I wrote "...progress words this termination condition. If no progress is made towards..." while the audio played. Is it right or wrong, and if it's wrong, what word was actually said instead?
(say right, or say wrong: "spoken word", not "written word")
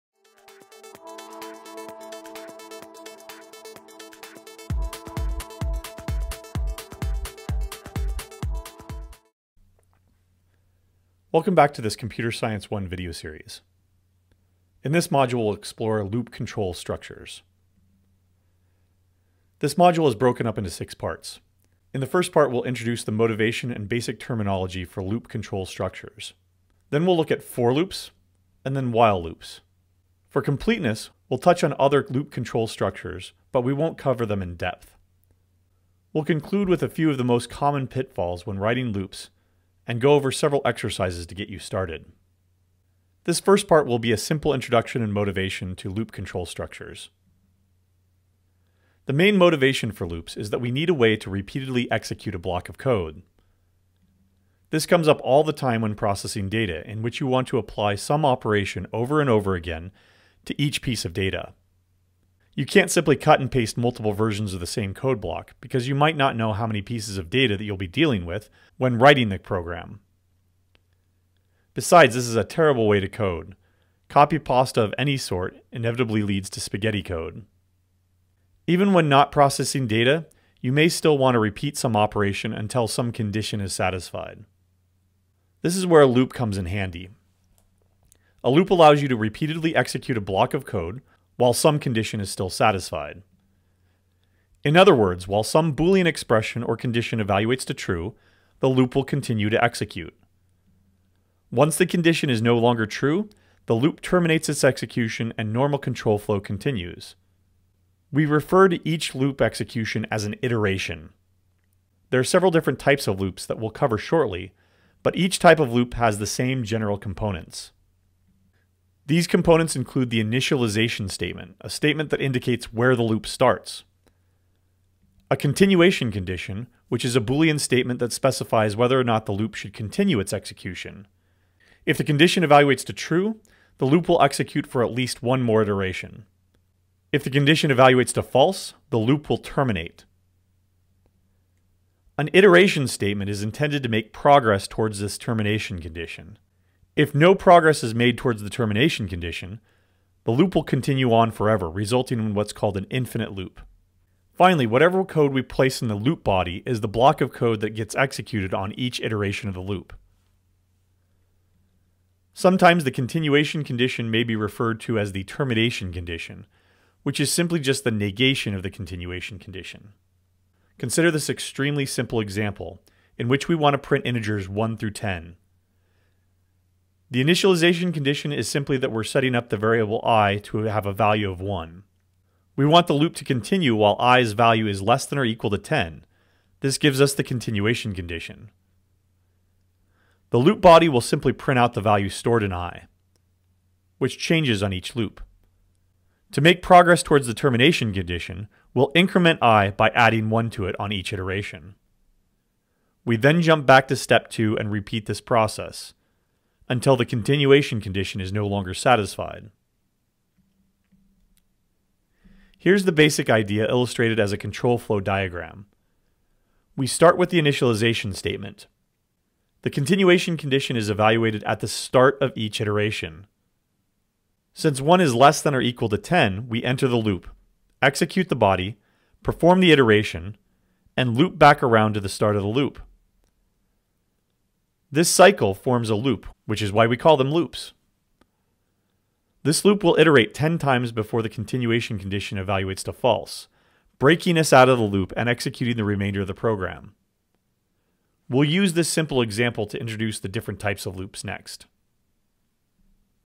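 wrong: "towards", not "words".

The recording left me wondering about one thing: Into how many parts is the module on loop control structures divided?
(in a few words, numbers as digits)
6.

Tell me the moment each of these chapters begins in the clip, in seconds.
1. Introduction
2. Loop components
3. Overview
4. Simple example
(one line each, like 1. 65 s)
1. 42 s
2. 118 s
3. 10 s
4. 170 s.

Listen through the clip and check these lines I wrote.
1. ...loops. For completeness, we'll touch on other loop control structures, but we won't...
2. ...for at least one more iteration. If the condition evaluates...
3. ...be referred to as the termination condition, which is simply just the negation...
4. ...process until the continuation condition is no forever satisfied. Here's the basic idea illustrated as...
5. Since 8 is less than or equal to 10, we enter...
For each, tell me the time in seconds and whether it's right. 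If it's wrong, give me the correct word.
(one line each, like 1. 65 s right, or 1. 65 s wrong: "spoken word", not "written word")
1. 29 s right
2. 134 s right
3. 164 s right
4. 205 s wrong: "longer", not "forever"
5. 224 s wrong: "1", not "8".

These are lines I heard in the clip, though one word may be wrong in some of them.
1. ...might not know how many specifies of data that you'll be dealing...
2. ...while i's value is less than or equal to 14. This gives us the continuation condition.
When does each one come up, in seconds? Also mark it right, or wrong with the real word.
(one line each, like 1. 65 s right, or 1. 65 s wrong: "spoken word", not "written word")
1. 65 s wrong: "pieces", not "specifies"
2. 183 s wrong: "10", not "14".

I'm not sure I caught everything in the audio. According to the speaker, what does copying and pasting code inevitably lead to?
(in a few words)
spaghetti code.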